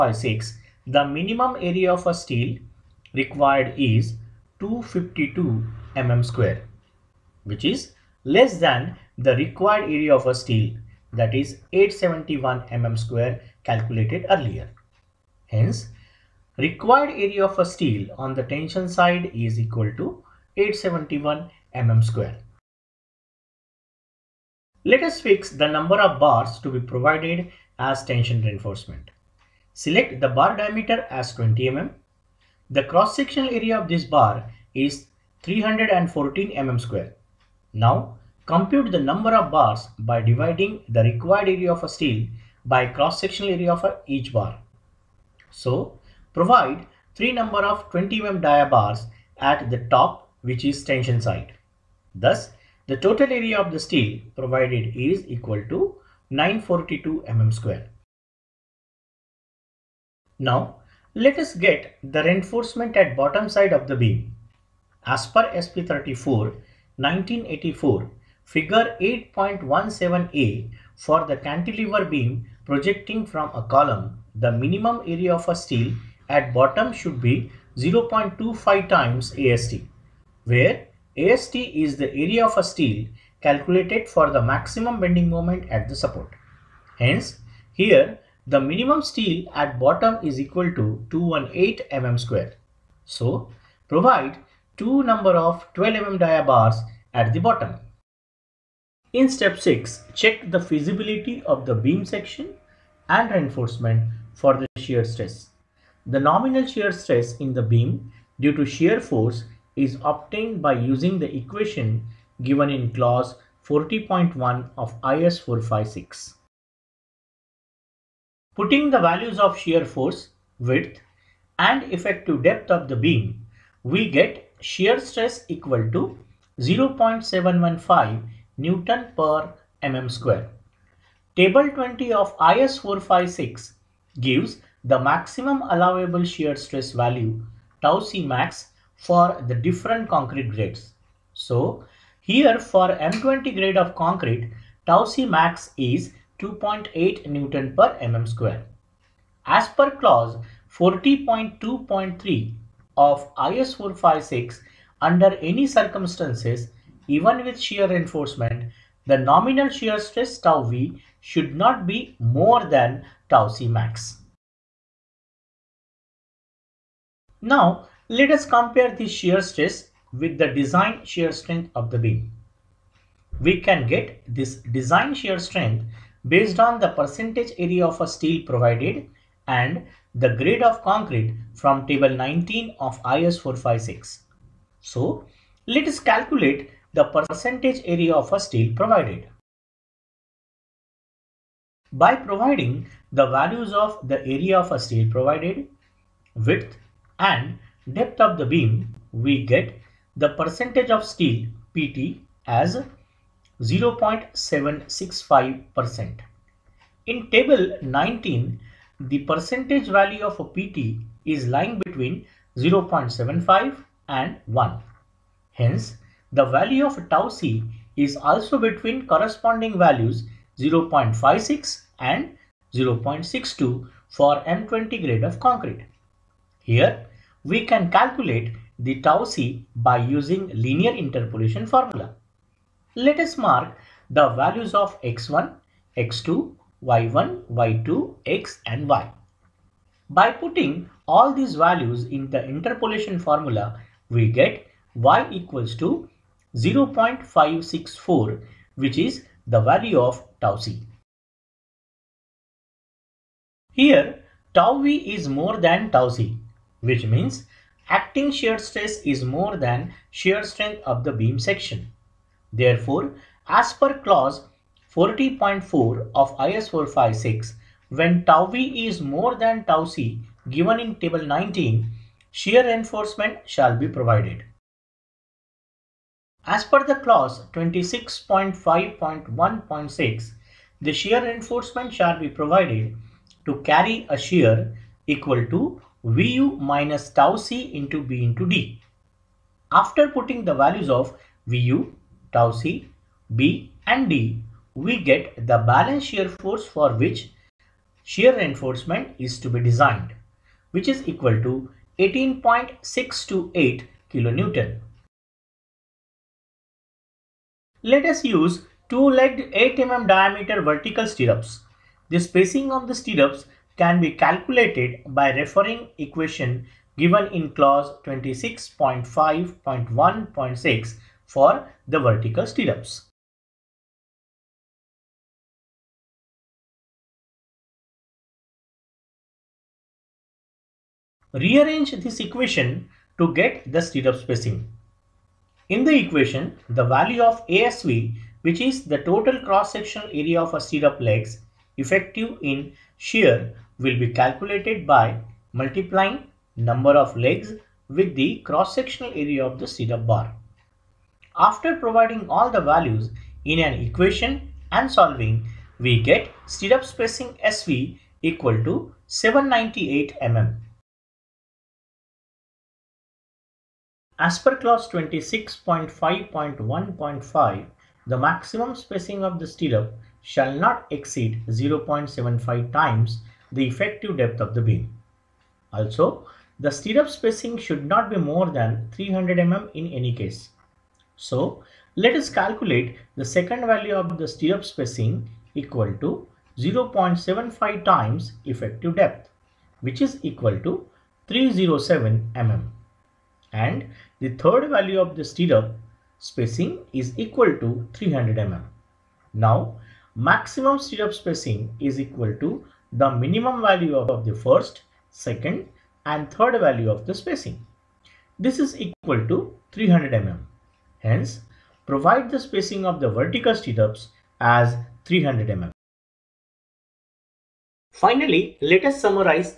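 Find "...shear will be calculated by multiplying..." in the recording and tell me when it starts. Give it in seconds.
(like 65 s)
342 s.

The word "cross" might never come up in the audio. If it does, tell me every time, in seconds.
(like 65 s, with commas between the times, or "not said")
32 s, 42 s, 339 s, 348 s.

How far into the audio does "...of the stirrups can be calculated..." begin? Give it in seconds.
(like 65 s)
312 s.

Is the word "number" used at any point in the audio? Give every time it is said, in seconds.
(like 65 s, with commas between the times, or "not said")
25 s, 39 s, 47 s, 95 s, 346 s.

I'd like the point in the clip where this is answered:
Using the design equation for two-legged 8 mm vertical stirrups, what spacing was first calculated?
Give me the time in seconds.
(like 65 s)
359 s.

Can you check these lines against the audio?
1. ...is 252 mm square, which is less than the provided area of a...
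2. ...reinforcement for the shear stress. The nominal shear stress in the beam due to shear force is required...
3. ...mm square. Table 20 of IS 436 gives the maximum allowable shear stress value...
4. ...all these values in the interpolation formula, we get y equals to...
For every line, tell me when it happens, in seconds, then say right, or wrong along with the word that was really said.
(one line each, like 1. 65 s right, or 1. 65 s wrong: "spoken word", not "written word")
1. 3 s wrong: "required", not "provided"
2. 103 s wrong: "obtained", not "required"
3. 129 s wrong: "456", not "436"
4. 241 s right.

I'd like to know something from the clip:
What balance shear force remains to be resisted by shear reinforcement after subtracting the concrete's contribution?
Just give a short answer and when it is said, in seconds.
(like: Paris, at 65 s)
18.628 kN, at 301 s.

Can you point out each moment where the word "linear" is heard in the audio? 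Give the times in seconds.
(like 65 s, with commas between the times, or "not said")
230 s.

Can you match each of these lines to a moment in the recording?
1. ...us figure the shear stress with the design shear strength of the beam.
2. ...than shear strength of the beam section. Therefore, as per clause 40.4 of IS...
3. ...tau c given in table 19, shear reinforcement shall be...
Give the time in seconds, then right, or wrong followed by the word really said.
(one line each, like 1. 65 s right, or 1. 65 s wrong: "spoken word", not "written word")
1. 168 s wrong: "compare", not "figure"
2. 259 s right
3. 269 s right.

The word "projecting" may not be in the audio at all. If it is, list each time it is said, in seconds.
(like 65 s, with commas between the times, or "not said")
72 s.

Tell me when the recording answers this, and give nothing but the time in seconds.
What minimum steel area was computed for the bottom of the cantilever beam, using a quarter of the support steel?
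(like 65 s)
91 s.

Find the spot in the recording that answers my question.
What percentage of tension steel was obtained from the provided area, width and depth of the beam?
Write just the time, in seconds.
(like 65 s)
203 s.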